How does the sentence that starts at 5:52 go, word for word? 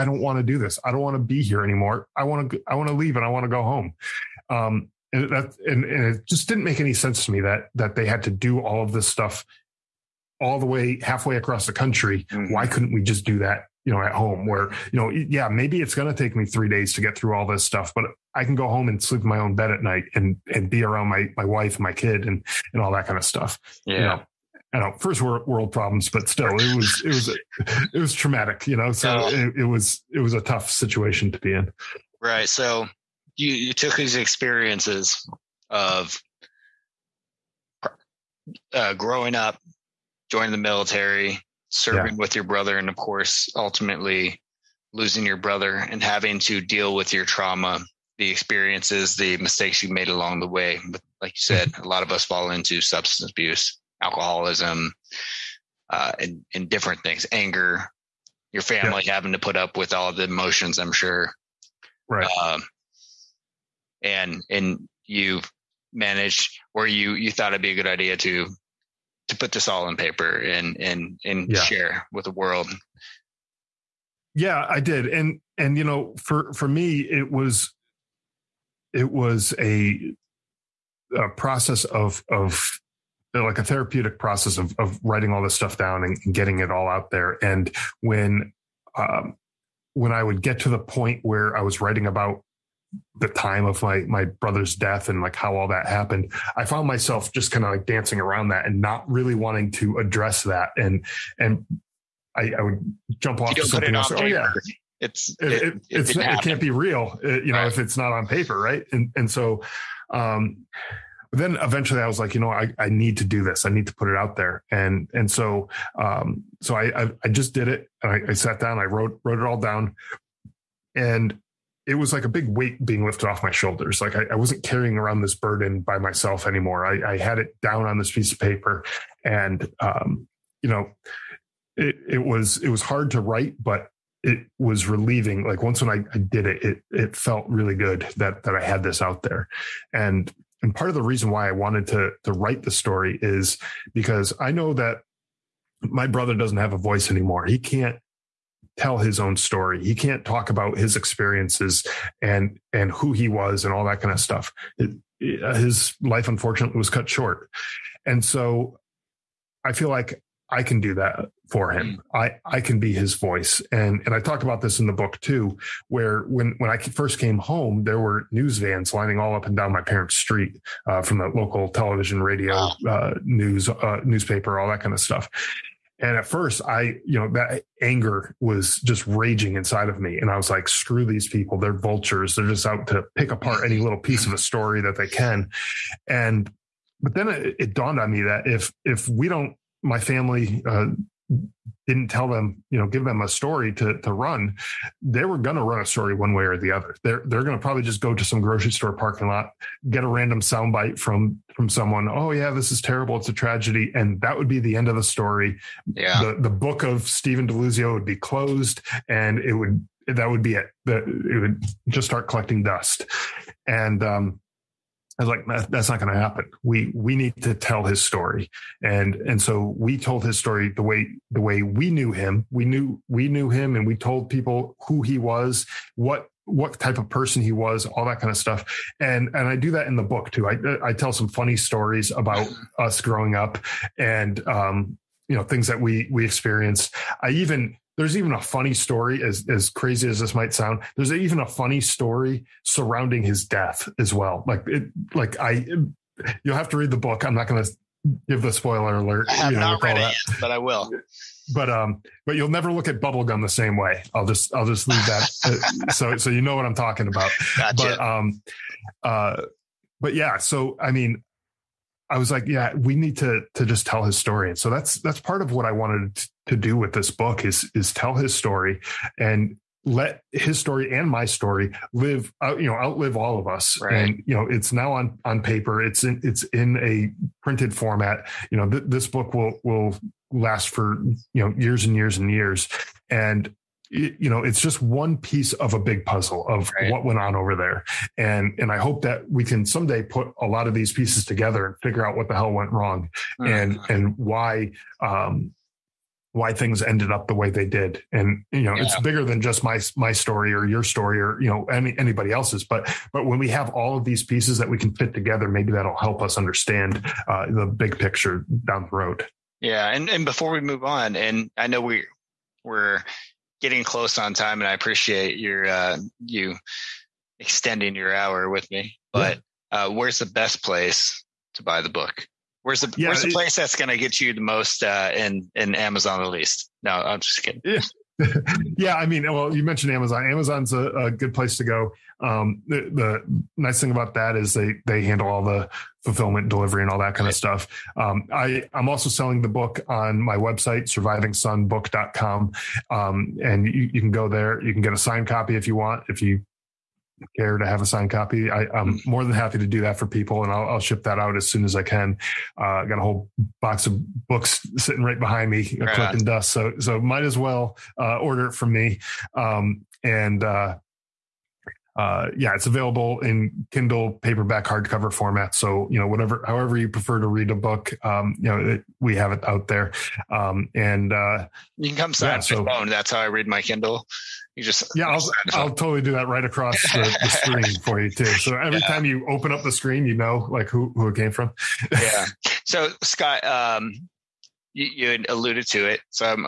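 Uh, I got a whole box of books sitting right behind me, uh, right collecting on.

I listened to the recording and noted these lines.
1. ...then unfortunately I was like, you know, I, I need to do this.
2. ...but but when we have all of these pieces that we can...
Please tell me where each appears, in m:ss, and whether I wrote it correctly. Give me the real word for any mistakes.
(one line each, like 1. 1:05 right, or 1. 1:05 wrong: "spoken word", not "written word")
1. 1:51 wrong: "eventually", not "unfortunately"
2. 5:02 right.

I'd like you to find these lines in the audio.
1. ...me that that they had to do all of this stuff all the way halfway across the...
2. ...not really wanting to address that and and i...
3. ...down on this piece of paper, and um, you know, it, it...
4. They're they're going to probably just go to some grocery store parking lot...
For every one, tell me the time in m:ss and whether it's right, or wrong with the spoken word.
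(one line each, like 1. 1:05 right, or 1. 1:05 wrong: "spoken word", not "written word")
1. 0:07 right
2. 1:38 right
3. 2:07 right
4. 3:17 right.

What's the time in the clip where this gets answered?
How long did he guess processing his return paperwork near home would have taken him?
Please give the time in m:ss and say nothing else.
0:16.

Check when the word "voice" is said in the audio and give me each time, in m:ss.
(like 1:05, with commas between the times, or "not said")
2:26, 2:43.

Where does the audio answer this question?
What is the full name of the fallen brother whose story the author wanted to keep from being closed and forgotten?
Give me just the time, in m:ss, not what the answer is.
3:27.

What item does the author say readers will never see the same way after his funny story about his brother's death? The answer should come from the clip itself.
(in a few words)
Bubblegum.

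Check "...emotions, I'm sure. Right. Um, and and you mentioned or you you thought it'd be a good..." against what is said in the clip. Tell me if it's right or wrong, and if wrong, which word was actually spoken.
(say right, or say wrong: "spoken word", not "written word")
wrong: "managed", not "mentioned".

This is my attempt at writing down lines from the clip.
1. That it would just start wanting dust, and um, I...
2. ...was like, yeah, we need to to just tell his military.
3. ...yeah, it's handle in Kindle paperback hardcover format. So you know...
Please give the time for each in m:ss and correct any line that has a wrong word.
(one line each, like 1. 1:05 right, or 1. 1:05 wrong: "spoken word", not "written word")
1. 3:30 wrong: "collecting", not "wanting"
2. 4:22 wrong: "story", not "military"
3. 6:02 wrong: "available", not "handle".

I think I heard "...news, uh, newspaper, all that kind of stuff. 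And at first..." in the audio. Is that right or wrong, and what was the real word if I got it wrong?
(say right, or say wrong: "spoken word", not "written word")
right.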